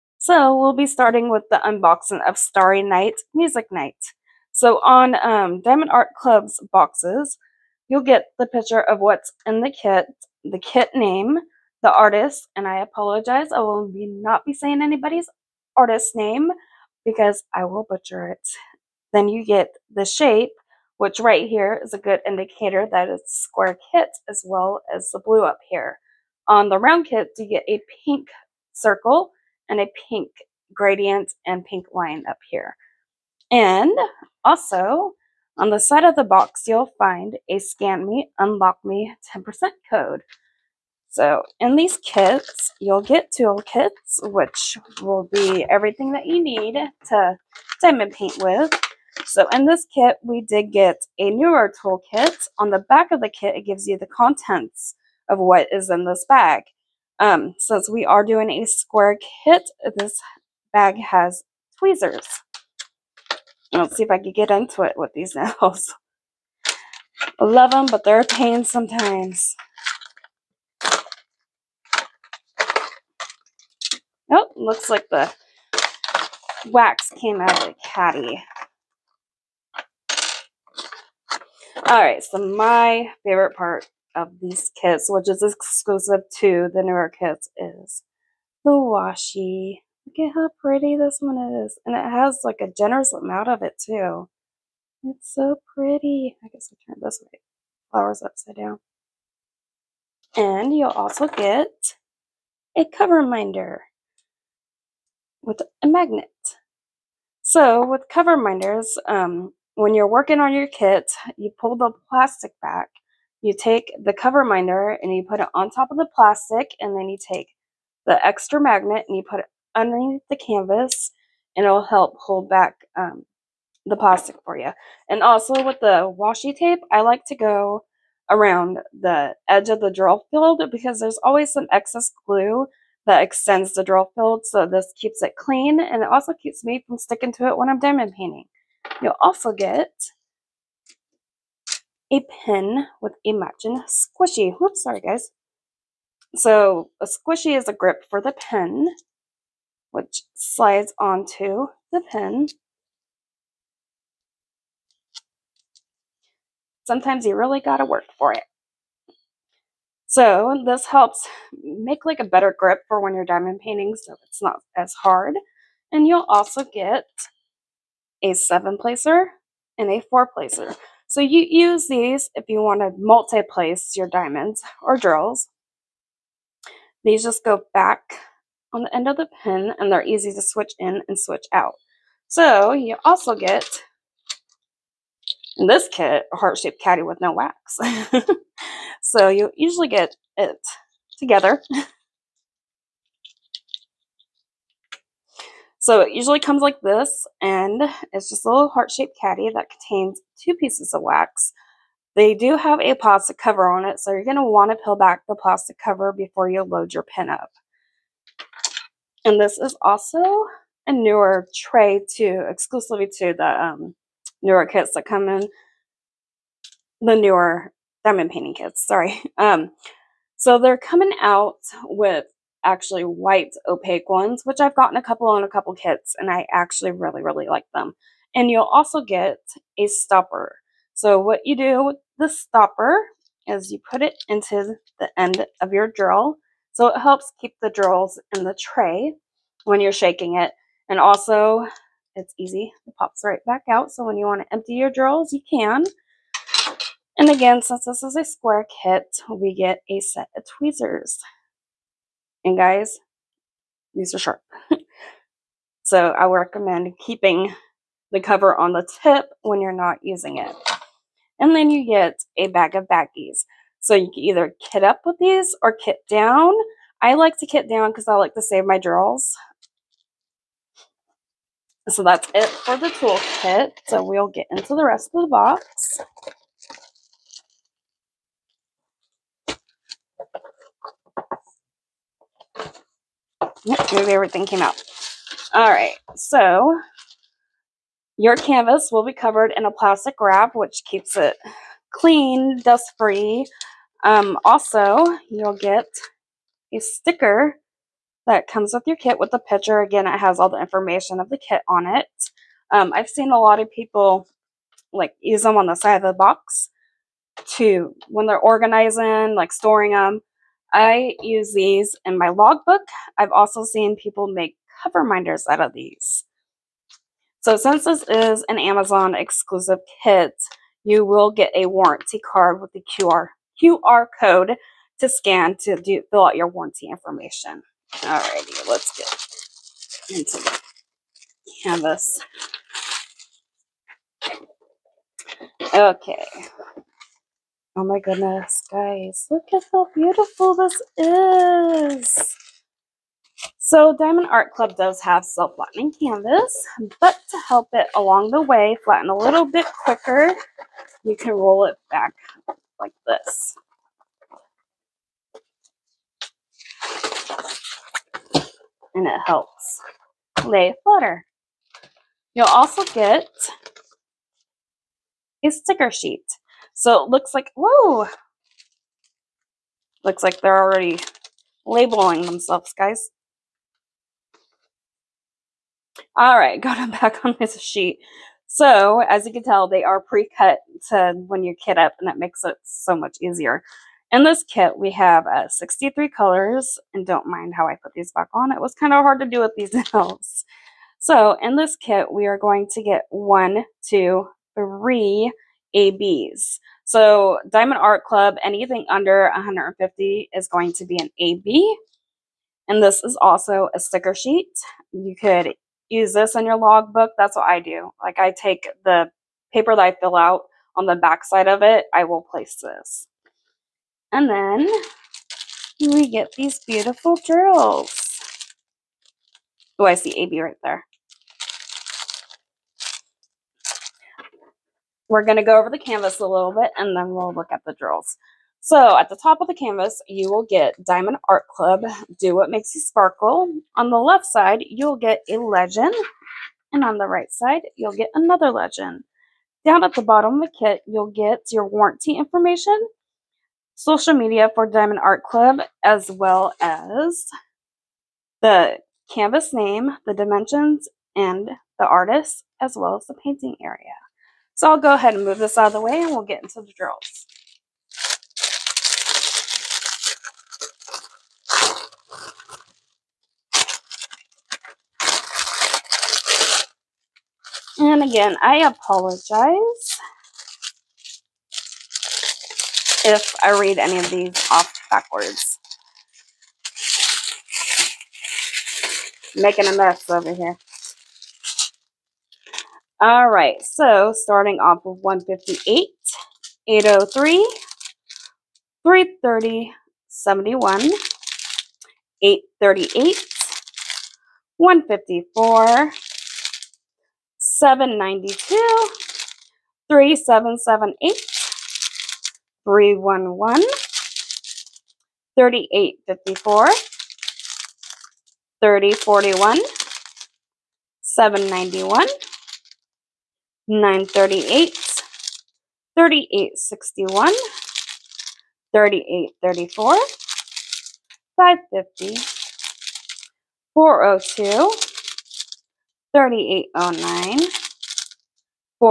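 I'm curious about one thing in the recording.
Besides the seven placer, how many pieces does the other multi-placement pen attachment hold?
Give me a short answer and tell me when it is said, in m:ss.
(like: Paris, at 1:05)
4, at 2:50.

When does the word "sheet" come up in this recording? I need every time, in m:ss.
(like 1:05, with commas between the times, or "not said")
6:05, 6:17, 6:44.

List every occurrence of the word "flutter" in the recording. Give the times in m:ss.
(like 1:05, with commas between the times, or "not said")
6:00.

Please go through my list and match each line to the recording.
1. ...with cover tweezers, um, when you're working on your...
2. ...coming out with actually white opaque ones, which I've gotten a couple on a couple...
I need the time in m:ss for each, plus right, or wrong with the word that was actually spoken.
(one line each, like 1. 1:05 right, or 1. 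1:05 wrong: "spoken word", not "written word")
1. 1:47 wrong: "minders", not "tweezers"
2. 3:40 right.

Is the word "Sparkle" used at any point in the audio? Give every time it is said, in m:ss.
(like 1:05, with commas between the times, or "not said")
7:12.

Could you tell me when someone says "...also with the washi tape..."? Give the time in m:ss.
2:05.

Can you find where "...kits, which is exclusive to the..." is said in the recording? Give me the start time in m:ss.
1:24.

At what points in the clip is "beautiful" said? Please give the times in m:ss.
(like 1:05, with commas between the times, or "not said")
5:39, 6:56.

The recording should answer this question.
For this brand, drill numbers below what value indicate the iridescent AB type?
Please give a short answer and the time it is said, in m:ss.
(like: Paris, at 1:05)
150, at 6:39.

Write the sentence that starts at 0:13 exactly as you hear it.
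I will be not be saying anybody's artist name because I will butcher it.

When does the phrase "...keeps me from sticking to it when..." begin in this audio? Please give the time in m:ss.
2:16.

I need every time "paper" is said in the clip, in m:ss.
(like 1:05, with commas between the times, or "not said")
6:49.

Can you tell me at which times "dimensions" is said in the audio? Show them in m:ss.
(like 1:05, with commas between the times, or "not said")
7:30.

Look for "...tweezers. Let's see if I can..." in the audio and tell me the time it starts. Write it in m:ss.
1:01.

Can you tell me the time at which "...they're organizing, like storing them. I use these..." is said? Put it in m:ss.
5:08.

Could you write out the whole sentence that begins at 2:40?
So this helps make like a better grip for when you're diamond painting so it's not as hard.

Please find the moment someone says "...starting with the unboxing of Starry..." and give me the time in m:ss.
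0:00.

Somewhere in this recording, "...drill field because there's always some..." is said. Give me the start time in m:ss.
2:09.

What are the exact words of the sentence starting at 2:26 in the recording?
So a squishy is a grip for the pen which slides onto the pin.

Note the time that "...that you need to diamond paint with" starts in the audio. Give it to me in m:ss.
0:46.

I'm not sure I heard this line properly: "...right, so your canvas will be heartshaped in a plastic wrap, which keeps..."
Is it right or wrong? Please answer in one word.
wrong.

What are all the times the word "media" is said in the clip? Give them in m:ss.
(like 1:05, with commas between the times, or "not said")
7:24.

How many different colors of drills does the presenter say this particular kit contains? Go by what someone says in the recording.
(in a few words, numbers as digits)
63.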